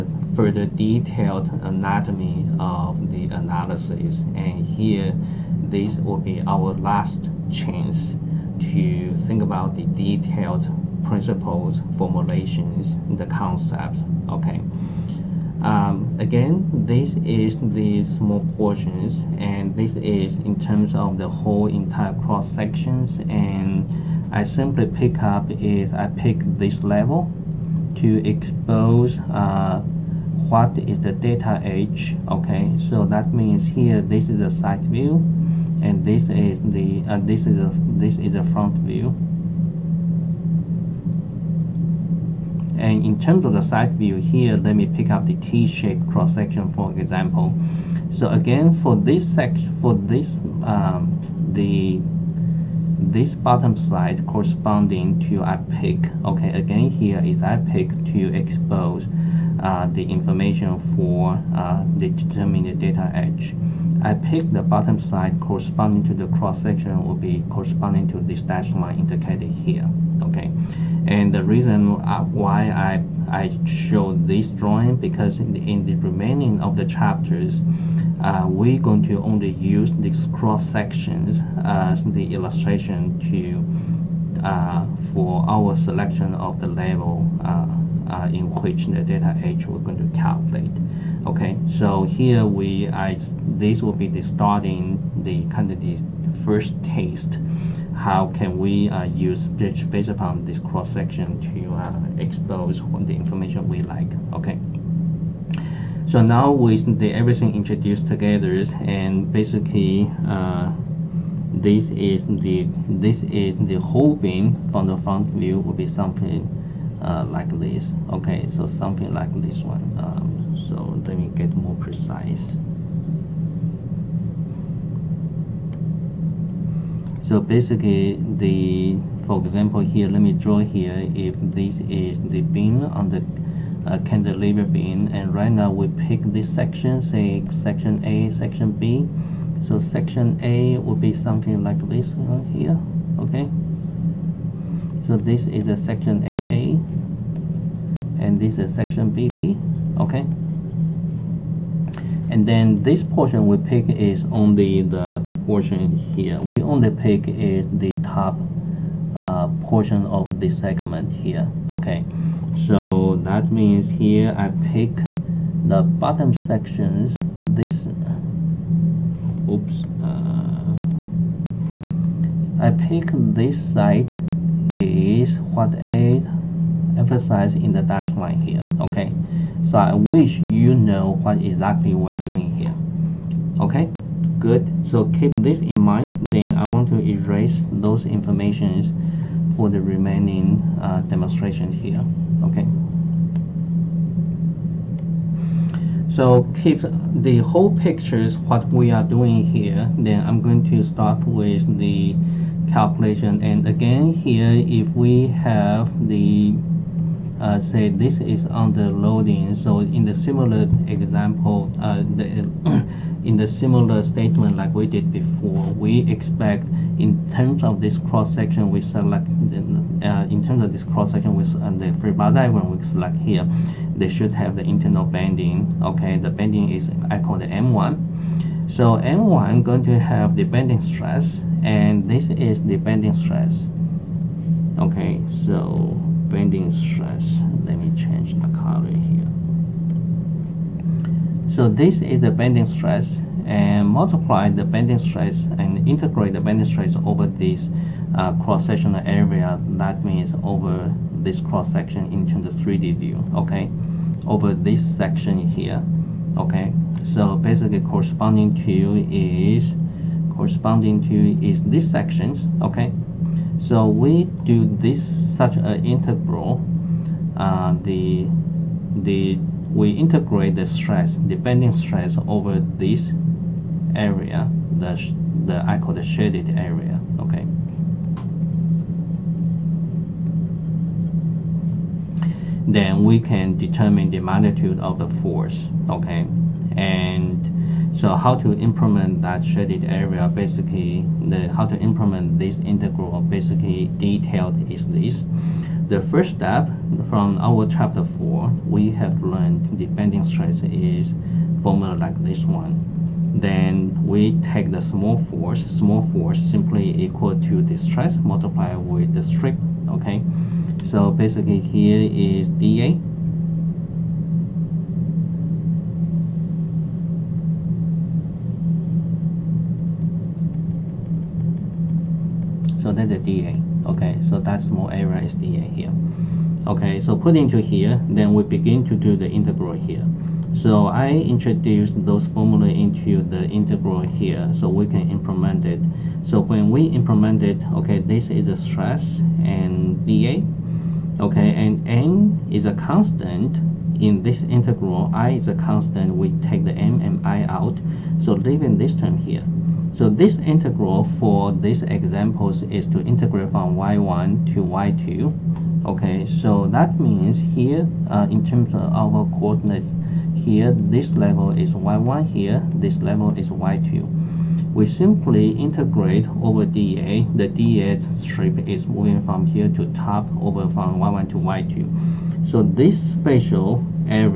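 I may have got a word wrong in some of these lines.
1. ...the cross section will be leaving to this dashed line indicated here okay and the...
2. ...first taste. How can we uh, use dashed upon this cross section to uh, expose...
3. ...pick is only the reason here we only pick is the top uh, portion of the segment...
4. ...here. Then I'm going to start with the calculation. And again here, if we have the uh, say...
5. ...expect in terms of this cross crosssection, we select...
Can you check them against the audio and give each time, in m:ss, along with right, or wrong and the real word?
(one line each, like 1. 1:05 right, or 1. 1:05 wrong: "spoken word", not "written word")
1. 1:06 wrong: "corresponding", not "leaving"
2. 1:36 wrong: "based", not "dashed"
3. 2:33 wrong: "portion", not "reason"
4. 3:19 right
5. 3:36 wrong: "section", not "crosssection".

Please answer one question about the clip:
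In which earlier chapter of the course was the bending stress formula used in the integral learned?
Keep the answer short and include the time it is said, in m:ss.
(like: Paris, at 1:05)
Chapter 4, at 4:57.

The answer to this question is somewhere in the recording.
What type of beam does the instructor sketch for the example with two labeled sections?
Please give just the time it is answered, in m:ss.
2:14.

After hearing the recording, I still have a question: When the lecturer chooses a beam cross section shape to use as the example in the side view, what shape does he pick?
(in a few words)
T-shaped.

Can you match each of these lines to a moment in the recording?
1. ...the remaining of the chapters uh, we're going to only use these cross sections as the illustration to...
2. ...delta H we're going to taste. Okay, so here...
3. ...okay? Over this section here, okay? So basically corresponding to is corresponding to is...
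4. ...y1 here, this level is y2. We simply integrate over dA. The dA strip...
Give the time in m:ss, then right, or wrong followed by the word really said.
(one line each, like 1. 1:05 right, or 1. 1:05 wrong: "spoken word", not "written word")
1. 1:15 right
2. 1:29 wrong: "calculate", not "taste"
3. 4:13 right
4. 6:01 right.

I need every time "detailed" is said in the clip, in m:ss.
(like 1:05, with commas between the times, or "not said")
0:00, 0:09, 4:53.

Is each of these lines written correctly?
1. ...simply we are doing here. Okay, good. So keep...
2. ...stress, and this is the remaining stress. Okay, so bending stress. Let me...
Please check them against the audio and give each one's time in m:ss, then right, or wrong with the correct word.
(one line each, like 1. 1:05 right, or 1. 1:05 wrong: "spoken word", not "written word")
1. 3:01 wrong: "exactly", not "simply"
2. 3:50 wrong: "bending", not "remaining".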